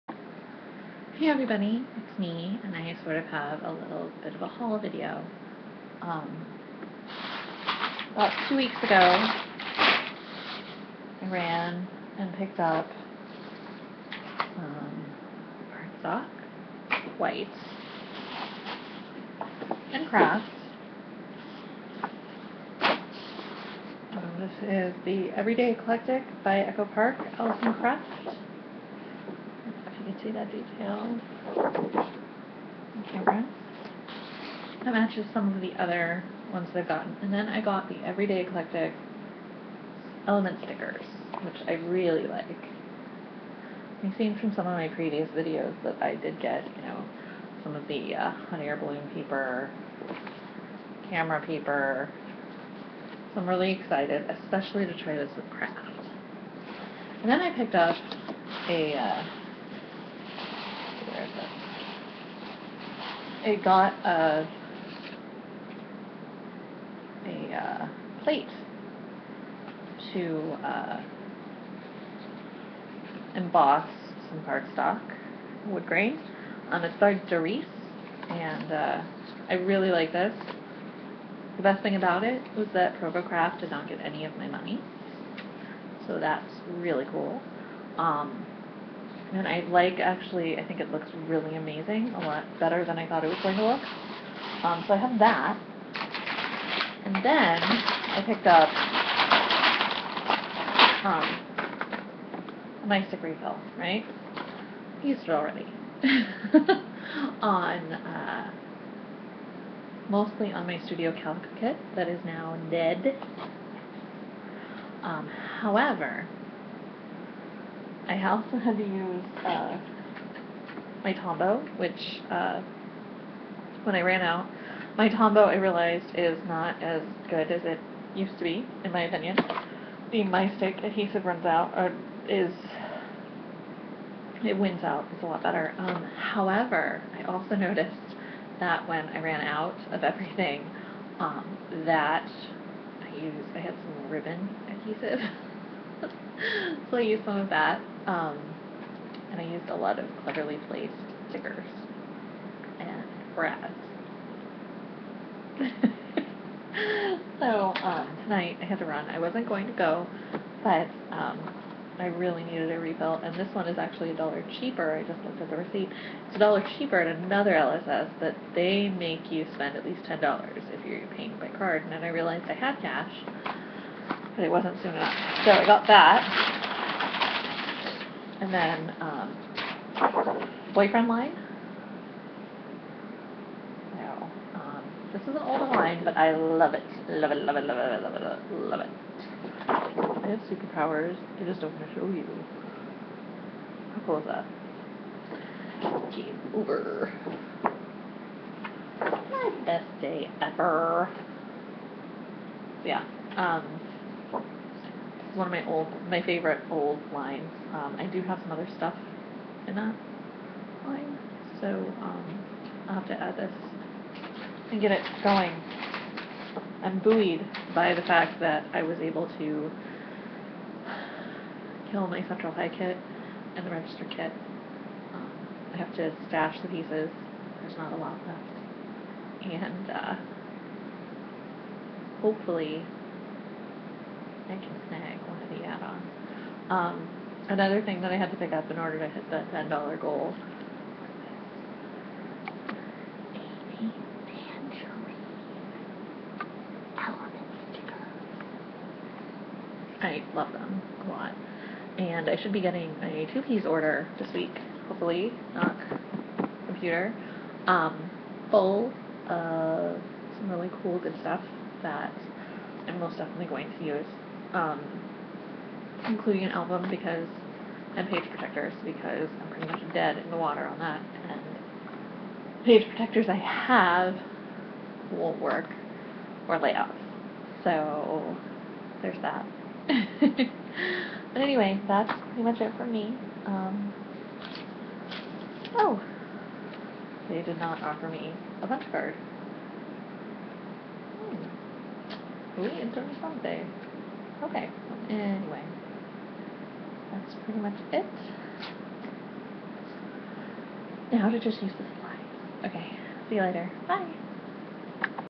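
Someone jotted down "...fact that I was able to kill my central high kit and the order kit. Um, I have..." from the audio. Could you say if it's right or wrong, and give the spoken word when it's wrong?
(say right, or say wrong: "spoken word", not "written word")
wrong: "register", not "order".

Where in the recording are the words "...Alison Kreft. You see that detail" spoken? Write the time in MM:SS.
00:27.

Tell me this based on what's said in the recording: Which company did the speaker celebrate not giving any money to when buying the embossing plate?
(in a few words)
ProvoCraft.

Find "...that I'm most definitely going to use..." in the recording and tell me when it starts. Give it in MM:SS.
04:21.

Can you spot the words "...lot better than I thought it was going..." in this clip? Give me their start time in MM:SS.
01:32.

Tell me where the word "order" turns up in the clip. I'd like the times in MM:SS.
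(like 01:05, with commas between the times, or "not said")
03:58, 04:13.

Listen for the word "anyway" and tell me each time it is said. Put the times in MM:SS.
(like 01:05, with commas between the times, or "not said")
04:41, 04:55.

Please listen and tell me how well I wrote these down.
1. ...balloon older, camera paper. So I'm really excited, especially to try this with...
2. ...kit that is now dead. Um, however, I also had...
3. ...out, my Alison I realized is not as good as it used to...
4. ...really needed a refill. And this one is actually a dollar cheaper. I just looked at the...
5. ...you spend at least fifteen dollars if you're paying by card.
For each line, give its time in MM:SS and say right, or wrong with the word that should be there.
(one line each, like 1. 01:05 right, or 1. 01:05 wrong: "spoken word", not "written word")
1. 00:48 wrong: "paper", not "older"
2. 01:51 right
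3. 02:04 wrong: "Tombow", not "Alison"
4. 02:42 right
5. 02:49 wrong: "ten", not "fifteen".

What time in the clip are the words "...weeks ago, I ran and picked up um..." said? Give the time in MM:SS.
00:08.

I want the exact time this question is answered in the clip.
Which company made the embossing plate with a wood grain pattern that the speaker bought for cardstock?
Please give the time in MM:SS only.
01:17.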